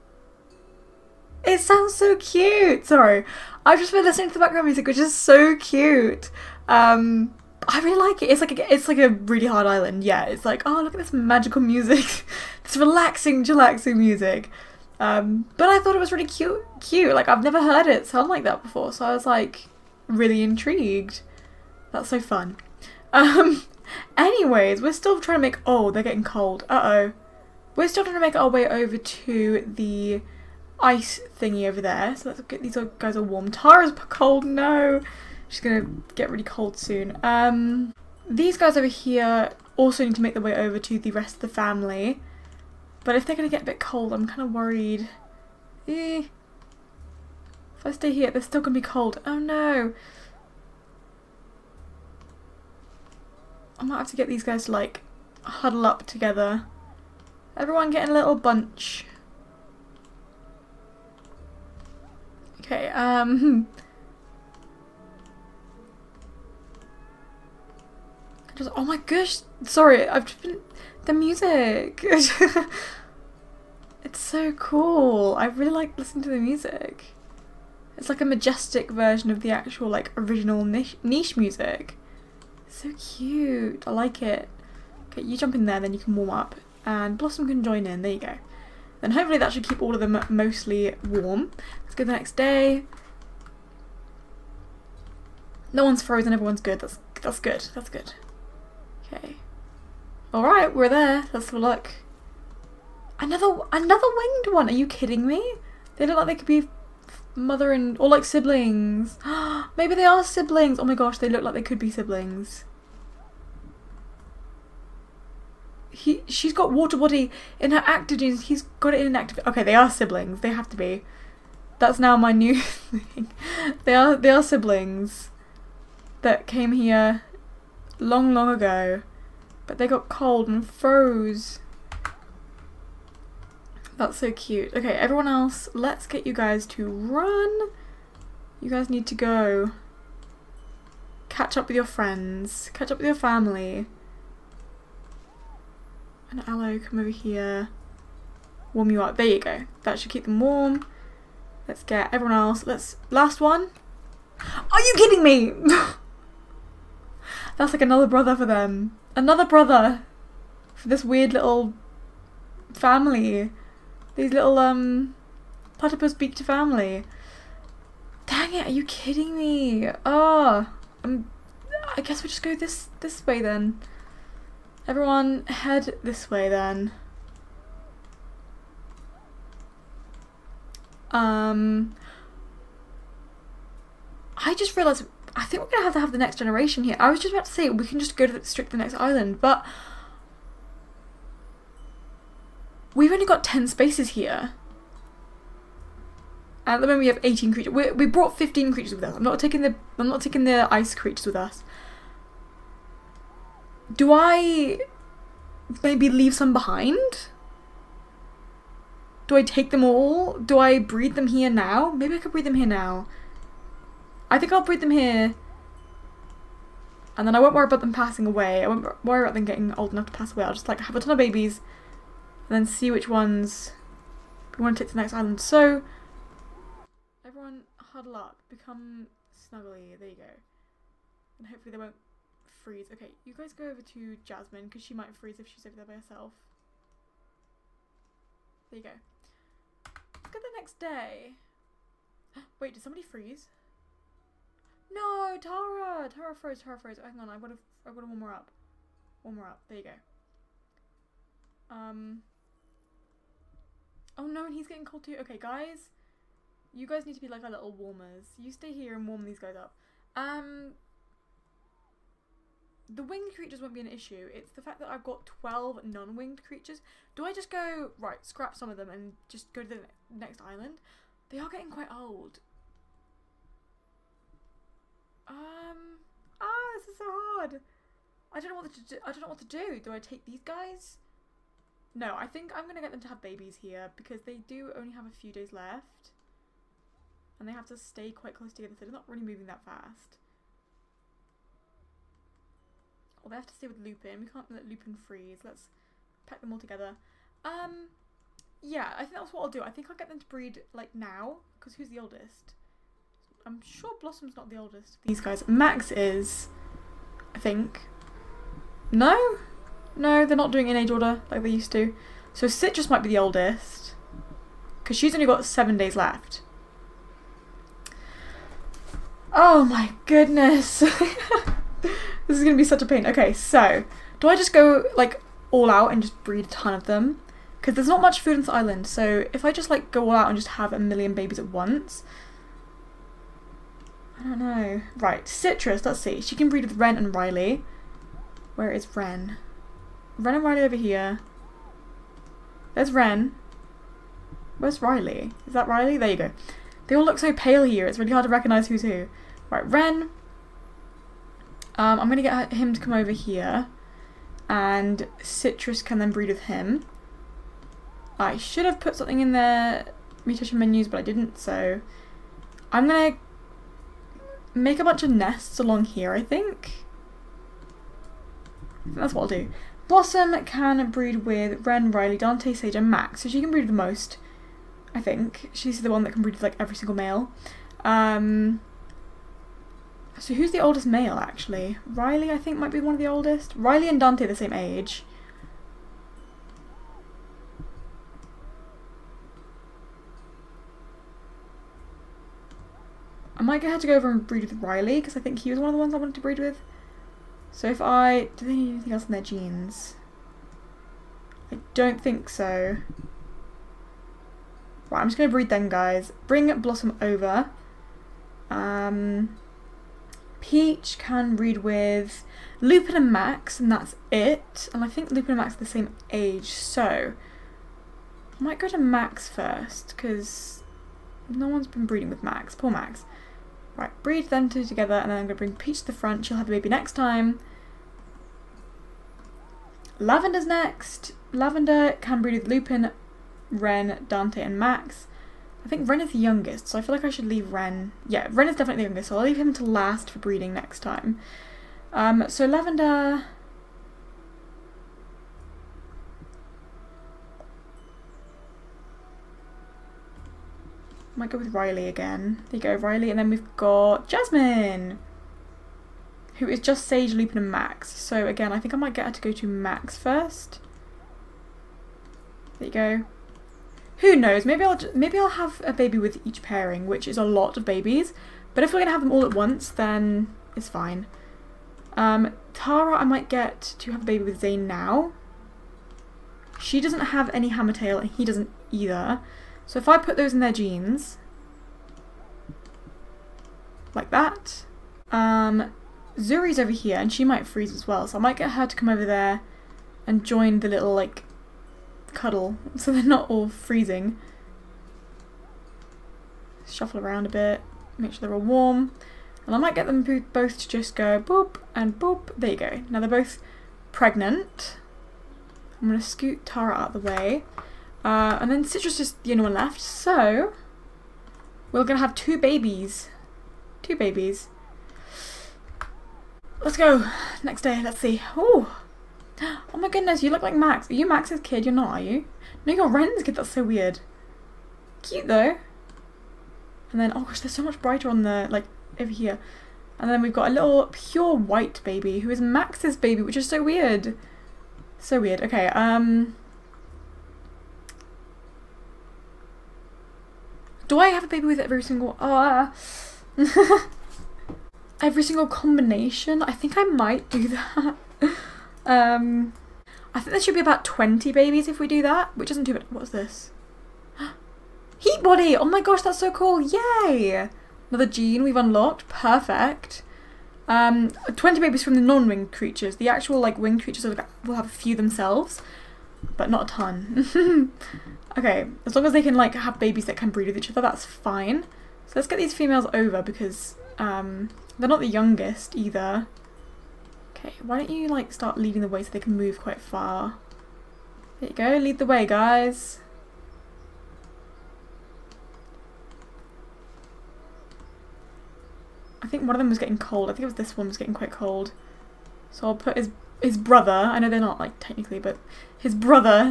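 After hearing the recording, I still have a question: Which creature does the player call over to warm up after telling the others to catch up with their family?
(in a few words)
Aloe.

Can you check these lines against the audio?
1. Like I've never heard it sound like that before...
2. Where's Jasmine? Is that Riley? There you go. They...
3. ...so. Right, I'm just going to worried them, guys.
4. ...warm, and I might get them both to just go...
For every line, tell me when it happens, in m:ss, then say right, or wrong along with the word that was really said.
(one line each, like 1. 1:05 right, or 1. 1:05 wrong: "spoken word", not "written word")
1. 0:17 right
2. 5:44 wrong: "Riley", not "Jasmine"
3. 6:42 wrong: "breed", not "worried"
4. 8:18 right.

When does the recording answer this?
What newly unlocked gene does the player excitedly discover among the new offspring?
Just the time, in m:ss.
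9:14.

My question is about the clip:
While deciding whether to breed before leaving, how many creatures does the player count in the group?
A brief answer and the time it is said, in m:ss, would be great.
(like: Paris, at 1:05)
18, at 3:17.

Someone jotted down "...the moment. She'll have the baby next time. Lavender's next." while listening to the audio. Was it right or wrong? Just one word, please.
wrong.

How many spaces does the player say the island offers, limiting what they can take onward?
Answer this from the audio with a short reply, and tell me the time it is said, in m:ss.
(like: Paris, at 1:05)
10, at 3:13.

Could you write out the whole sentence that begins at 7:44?
Maybe I'll maybe I'll have a baby with each pairing, which is a lot of babies.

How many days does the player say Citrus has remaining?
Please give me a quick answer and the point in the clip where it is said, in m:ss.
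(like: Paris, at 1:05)
7, at 5:15.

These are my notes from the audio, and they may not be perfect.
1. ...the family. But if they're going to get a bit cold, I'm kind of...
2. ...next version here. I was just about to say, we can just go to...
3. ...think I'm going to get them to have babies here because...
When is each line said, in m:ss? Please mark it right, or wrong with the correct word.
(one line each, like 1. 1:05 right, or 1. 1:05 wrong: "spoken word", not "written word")
1. 0:41 right
2. 3:06 wrong: "generation", not "version"
3. 4:42 right.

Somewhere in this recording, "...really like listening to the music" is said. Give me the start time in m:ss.
1:15.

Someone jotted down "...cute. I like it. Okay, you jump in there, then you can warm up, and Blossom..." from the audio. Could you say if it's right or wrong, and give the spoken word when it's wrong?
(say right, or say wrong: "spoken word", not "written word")
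right.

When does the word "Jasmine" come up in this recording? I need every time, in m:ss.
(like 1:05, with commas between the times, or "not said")
3:54, 7:34.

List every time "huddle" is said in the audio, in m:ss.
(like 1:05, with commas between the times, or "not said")
0:55, 3:47.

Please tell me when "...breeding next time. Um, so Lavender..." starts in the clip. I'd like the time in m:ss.
7:20.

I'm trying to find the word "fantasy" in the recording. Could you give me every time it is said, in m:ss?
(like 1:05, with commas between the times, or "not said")
not said.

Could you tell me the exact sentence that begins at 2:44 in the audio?
These little um platypus beaked family.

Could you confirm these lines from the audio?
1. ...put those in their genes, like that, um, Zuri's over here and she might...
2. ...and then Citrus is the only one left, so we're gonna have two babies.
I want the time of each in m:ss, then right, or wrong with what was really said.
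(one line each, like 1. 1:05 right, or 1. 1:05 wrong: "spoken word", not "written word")
1. 7:59 right
2. 8:28 right.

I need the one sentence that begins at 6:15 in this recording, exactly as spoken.
She's the one that can breed with like every single male.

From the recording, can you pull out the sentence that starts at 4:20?
Um, the winged creatures won't be an issue.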